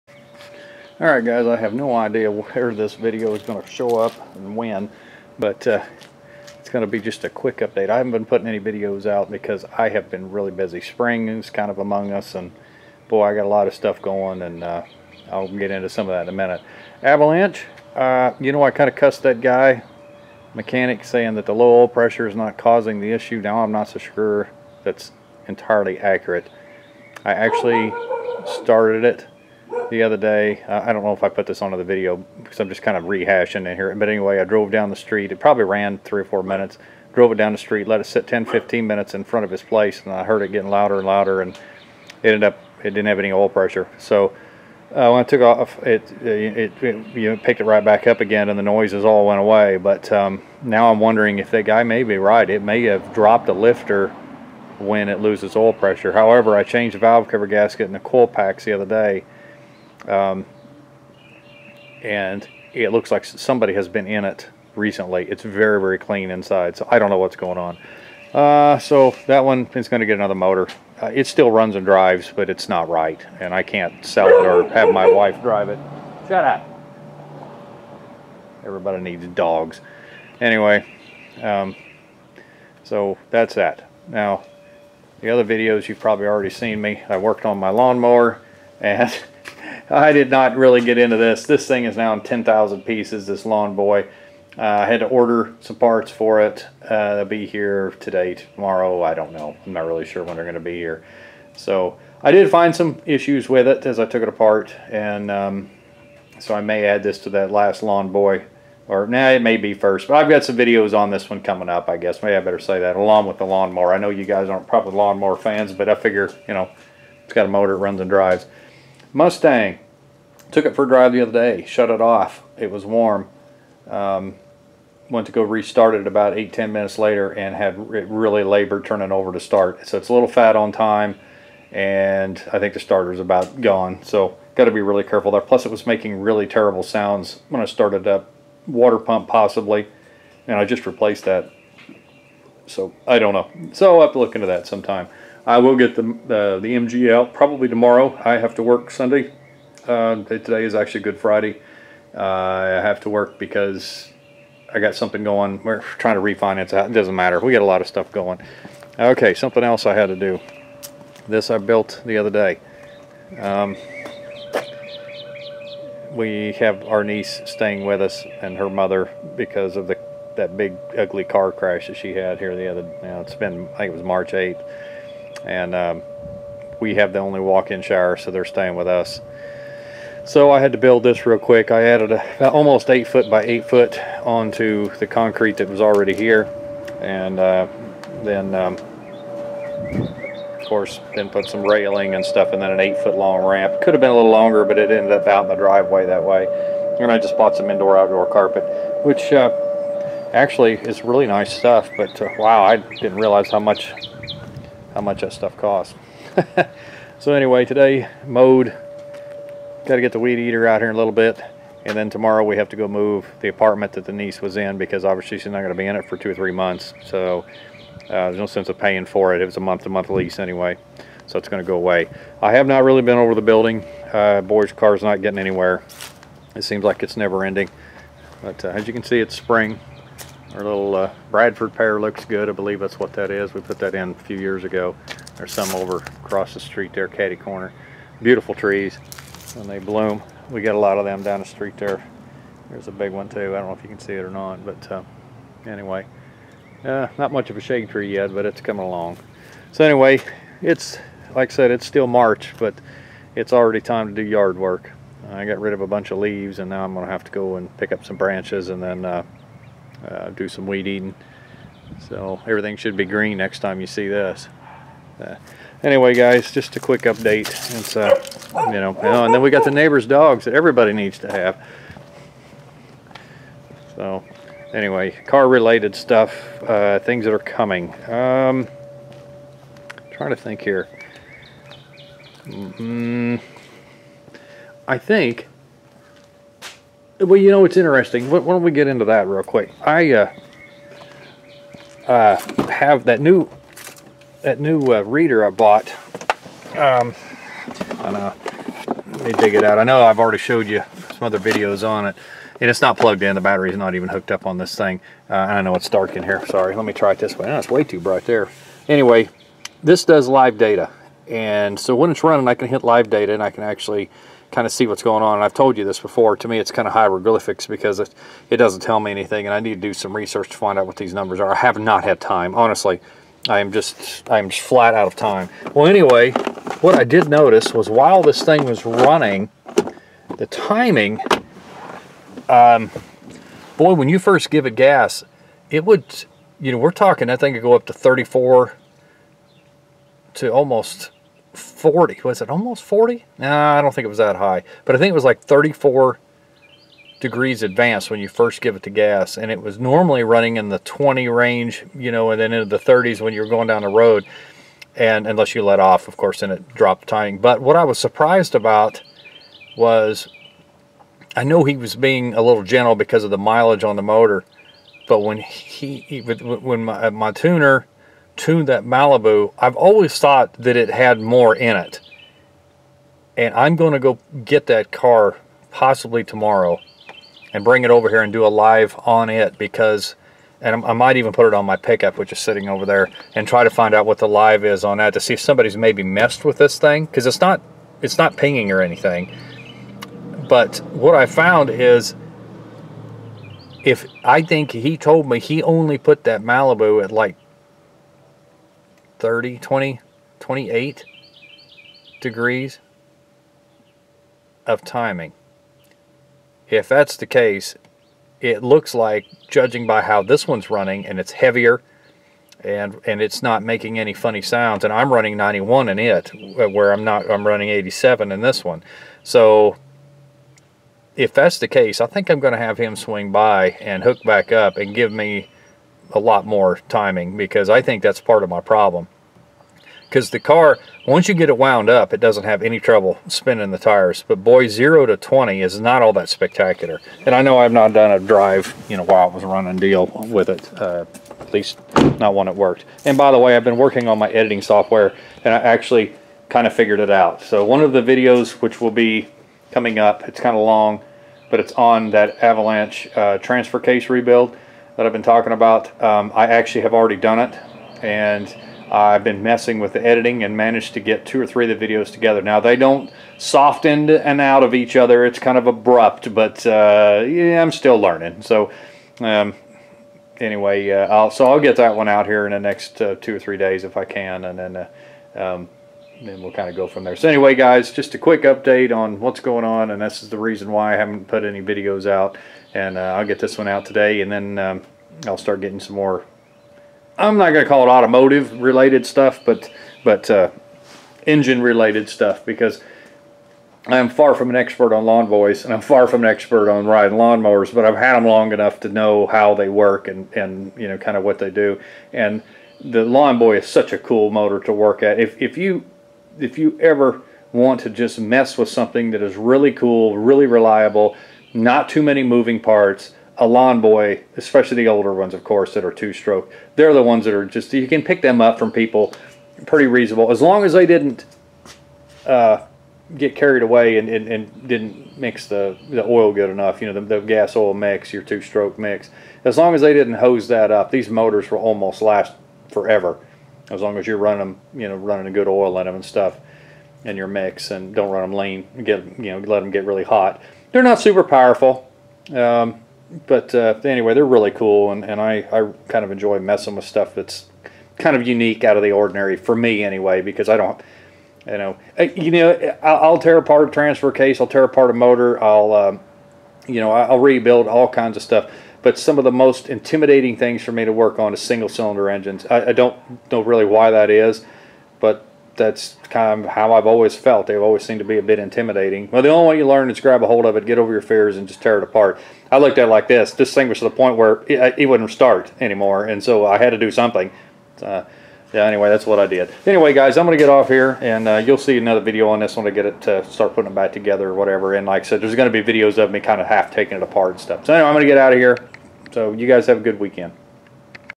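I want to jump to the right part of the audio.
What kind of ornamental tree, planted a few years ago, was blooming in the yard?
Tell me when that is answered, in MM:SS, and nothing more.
03:51.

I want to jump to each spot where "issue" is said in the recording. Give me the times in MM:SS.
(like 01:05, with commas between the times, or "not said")
00:23, 01:43.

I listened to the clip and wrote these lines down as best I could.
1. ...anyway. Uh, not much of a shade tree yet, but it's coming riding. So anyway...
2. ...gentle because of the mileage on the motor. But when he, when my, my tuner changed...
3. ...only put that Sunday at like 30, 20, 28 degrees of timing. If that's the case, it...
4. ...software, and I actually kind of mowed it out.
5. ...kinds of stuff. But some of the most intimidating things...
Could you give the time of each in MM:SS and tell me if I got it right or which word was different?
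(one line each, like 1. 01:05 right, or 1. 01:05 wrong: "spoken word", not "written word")
1. 04:05 wrong: "along", not "riding"
2. 06:02 wrong: "tuned", not "changed"
3. 06:35 wrong: "Malibu", not "Sunday"
4. 07:24 wrong: "figured", not "mowed"
5. 09:17 right.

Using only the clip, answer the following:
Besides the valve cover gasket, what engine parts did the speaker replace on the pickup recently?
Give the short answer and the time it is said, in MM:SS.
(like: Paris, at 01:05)
coil packs, at 00:57.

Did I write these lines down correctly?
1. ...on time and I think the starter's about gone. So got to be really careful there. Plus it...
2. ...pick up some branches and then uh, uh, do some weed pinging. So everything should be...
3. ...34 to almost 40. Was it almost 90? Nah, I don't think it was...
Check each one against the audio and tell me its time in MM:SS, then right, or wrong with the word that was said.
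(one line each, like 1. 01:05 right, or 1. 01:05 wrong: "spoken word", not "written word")
1. 02:10 right
2. 04:17 wrong: "eating", not "pinging"
3. 05:37 wrong: "40", not "90".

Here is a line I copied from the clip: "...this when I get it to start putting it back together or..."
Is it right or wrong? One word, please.
right.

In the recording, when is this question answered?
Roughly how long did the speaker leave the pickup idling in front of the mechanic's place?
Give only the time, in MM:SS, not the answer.
00:38.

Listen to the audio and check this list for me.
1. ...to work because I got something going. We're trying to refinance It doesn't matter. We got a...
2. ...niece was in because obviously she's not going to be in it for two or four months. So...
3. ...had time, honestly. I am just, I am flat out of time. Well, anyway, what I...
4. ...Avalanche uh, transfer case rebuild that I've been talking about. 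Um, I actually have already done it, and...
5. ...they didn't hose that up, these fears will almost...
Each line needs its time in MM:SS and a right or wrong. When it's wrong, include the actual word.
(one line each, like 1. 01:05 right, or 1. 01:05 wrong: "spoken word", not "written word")
1. 02:33 right
2. 03:34 wrong: "three", not "four"
3. 05:22 right
4. 07:32 right
5. 08:49 wrong: "motors", not "fears".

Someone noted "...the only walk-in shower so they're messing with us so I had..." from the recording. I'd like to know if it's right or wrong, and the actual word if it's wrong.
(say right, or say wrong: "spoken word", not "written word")
wrong: "staying", not "messing".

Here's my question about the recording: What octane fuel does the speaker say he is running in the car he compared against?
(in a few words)
91.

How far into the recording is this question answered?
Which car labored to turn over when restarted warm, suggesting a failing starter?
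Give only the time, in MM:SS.
01:59.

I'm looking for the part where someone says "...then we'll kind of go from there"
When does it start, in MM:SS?
07:56.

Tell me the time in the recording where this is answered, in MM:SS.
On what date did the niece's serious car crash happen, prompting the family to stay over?
02:54.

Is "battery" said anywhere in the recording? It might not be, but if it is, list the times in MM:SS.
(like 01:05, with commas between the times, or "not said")
05:03.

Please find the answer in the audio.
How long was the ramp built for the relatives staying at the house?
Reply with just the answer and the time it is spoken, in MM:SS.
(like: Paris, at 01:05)
8 feet, at 03:12.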